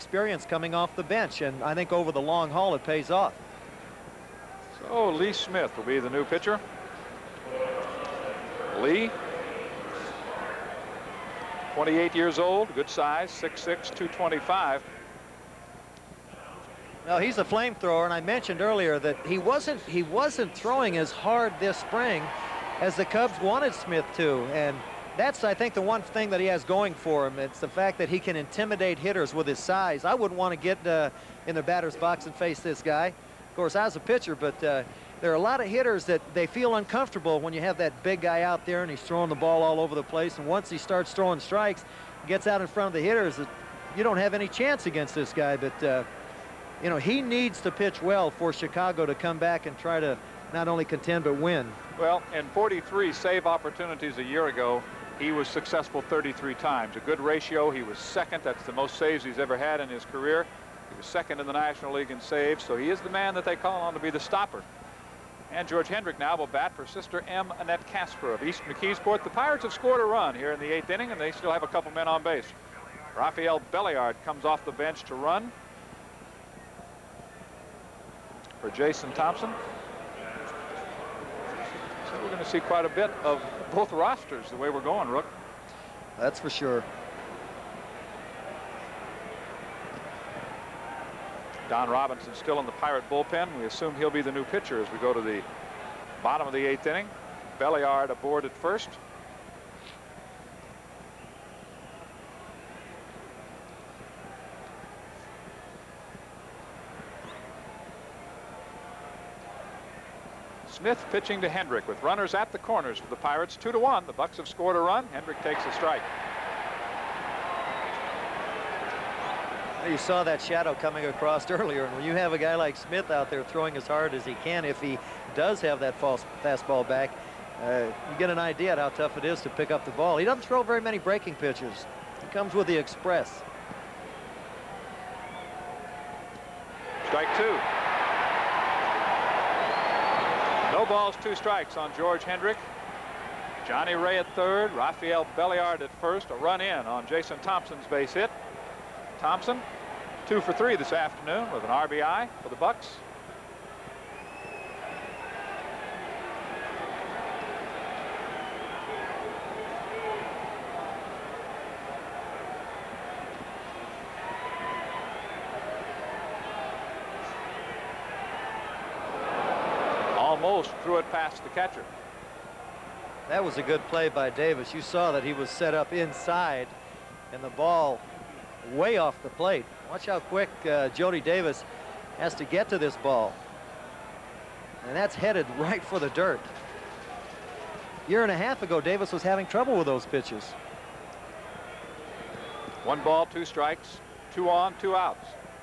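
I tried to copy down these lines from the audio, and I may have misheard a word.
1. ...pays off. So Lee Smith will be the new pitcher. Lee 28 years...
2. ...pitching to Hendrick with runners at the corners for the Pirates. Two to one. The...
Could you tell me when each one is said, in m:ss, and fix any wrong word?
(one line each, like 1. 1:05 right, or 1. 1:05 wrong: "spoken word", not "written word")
1. 0:02 right
2. 1:51 right.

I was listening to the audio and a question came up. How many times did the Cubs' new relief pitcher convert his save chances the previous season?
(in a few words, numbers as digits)
33.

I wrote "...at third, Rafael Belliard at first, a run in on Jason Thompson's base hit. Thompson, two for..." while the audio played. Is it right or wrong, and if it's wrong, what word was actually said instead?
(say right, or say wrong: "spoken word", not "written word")
right.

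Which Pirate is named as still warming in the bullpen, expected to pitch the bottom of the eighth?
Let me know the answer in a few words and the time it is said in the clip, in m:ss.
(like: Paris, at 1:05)
Don Robinson, at 1:31.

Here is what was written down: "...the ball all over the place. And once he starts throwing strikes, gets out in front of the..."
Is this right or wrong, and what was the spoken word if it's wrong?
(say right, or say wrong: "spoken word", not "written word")
right.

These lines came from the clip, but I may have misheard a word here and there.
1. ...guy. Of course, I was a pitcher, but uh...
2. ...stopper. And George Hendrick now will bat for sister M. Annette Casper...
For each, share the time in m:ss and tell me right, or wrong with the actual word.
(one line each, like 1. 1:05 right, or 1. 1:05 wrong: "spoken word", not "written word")
1. 0:32 right
2. 1:04 right.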